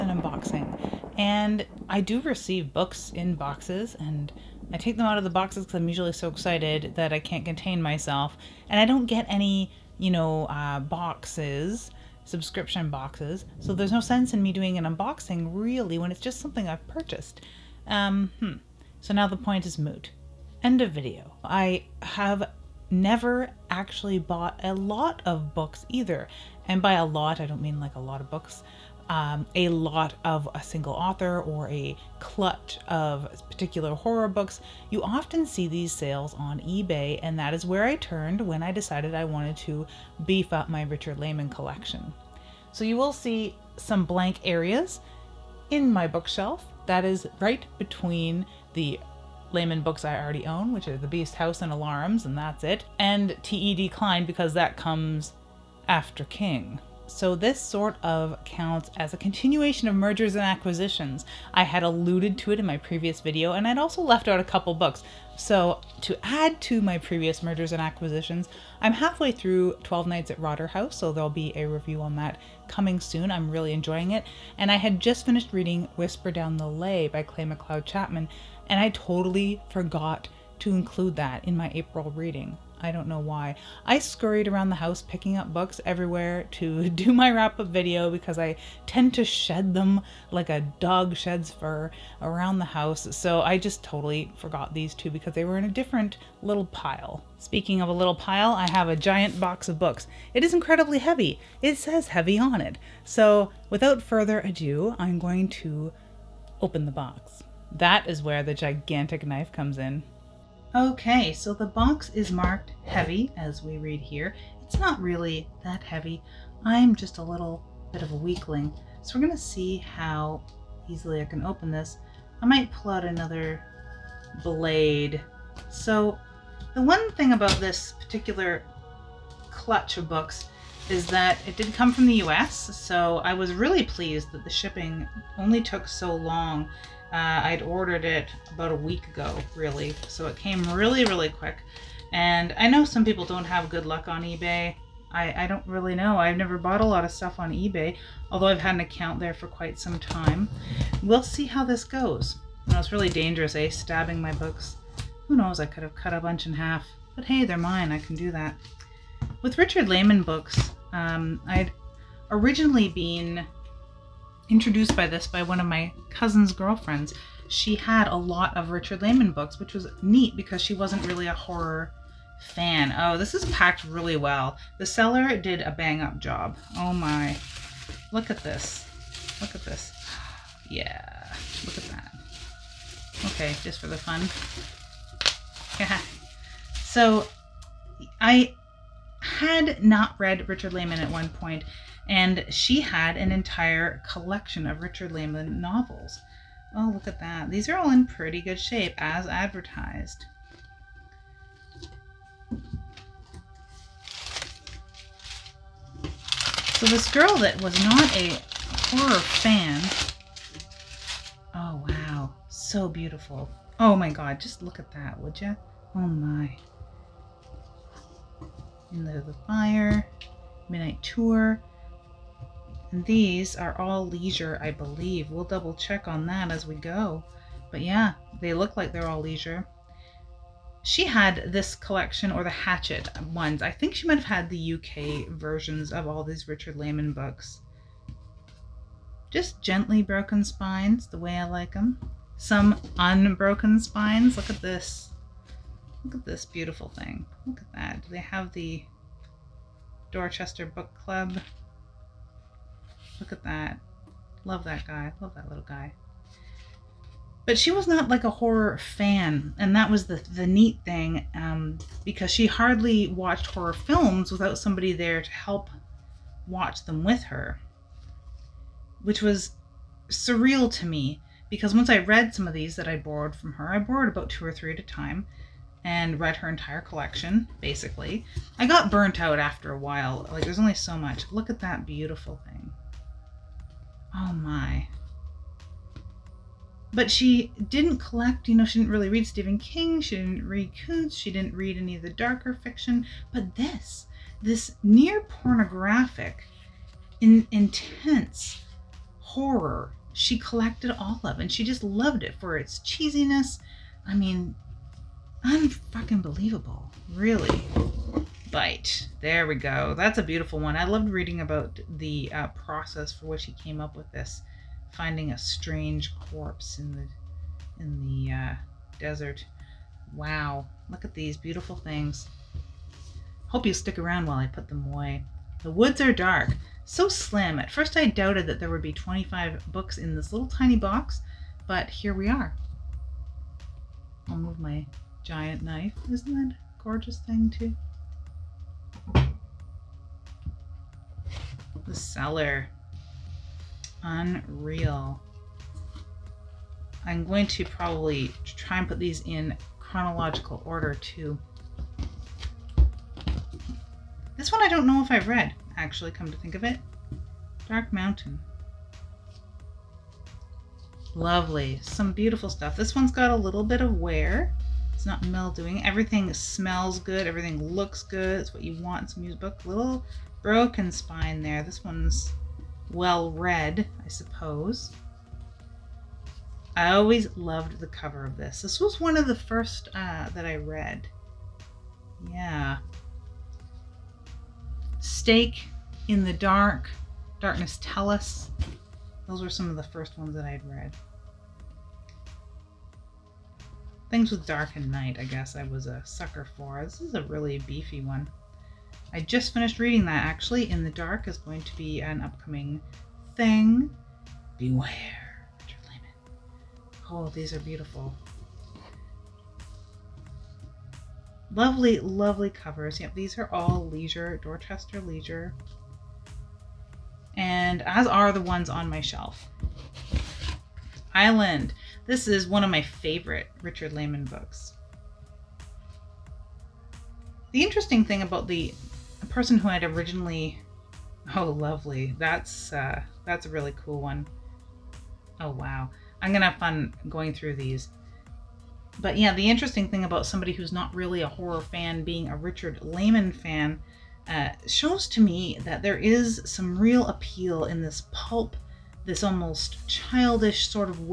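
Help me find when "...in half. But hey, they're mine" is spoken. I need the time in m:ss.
2:36.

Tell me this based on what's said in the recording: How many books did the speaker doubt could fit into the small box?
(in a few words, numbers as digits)
25.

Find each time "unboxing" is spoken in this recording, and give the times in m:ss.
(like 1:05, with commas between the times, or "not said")
0:00, 0:14.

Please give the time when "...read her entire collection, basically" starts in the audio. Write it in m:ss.
4:36.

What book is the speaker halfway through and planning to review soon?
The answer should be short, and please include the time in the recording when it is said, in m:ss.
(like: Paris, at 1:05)
12 Nights at Rotter House, at 1:09.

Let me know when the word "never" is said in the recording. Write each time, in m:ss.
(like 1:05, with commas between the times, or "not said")
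0:22, 2:26.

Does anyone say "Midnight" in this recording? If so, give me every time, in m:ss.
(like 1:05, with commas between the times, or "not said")
3:40.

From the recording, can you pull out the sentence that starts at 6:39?
I just finished reading that actually.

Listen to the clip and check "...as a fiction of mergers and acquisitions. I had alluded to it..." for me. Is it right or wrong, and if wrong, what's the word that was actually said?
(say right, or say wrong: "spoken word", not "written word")
wrong: "continuation", not "fiction".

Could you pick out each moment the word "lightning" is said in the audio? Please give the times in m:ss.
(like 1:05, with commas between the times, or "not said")
not said.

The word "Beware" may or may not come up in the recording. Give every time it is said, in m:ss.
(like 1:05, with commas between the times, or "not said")
6:44.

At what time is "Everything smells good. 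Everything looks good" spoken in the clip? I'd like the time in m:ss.
6:05.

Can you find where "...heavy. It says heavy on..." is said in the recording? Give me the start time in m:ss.
1:40.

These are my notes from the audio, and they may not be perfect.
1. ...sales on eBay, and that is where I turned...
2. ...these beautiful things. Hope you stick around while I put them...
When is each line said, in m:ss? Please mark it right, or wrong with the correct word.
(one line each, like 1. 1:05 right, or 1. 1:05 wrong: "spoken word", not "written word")
1. 0:35 right
2. 5:21 right.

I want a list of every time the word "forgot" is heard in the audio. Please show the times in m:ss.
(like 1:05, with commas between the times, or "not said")
1:19, 1:34.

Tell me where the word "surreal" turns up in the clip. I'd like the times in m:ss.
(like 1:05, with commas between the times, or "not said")
4:30.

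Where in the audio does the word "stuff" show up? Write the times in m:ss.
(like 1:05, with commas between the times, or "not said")
2:27, 6:02.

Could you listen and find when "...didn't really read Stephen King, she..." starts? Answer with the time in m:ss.
4:48.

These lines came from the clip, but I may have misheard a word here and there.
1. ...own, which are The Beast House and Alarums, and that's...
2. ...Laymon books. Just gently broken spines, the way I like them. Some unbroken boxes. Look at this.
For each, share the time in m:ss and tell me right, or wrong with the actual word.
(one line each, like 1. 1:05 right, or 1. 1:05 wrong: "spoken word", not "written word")
1. 0:50 right
2. 3:56 wrong: "spines", not "boxes".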